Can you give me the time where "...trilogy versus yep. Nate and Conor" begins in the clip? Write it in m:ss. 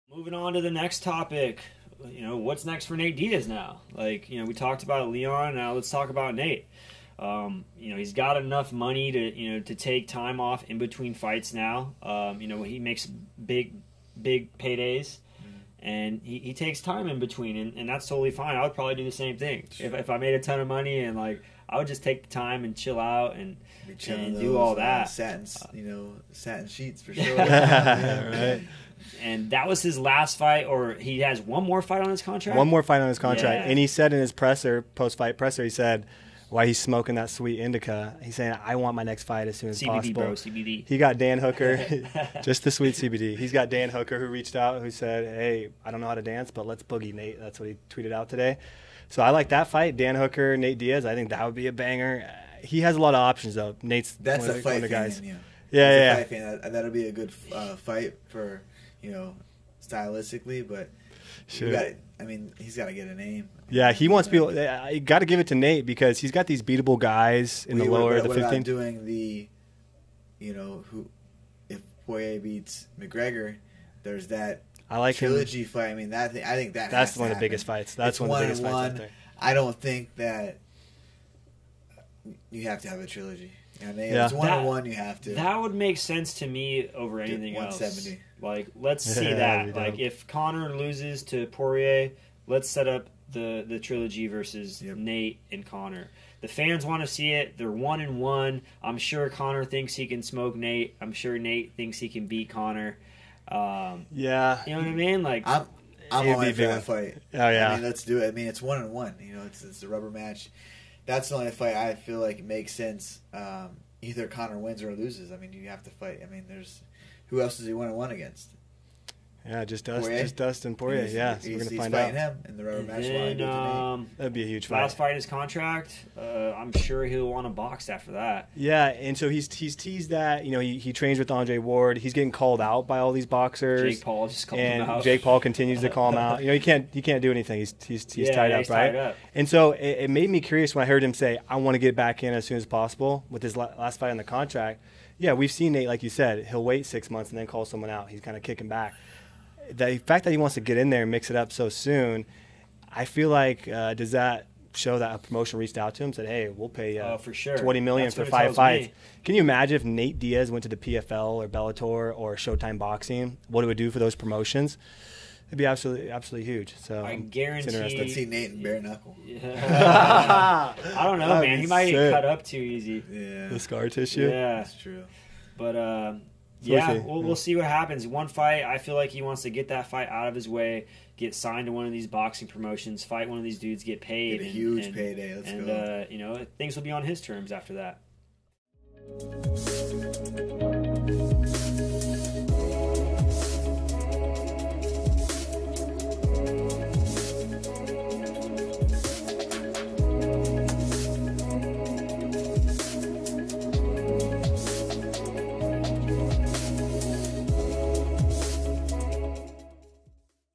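1:33.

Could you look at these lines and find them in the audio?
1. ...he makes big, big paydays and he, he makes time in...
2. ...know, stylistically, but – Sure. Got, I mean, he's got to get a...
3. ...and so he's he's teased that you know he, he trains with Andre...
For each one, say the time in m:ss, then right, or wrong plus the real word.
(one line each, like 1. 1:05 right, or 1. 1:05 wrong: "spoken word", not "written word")
1. 0:12 wrong: "takes", not "makes"
2. 0:59 right
3. 2:08 right.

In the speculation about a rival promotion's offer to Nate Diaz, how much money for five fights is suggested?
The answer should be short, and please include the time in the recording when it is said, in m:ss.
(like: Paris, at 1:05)
20 million, at 2:37.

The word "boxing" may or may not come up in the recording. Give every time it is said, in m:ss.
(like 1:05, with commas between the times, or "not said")
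2:42, 3:02.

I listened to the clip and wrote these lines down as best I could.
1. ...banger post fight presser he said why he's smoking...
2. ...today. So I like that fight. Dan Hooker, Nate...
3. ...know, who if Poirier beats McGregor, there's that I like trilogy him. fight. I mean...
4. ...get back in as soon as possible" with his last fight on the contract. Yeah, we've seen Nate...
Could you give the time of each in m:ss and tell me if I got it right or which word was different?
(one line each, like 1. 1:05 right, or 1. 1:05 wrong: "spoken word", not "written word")
1. 0:34 wrong: "presser", not "banger"
2. 0:48 right
3. 1:10 right
4. 2:21 right.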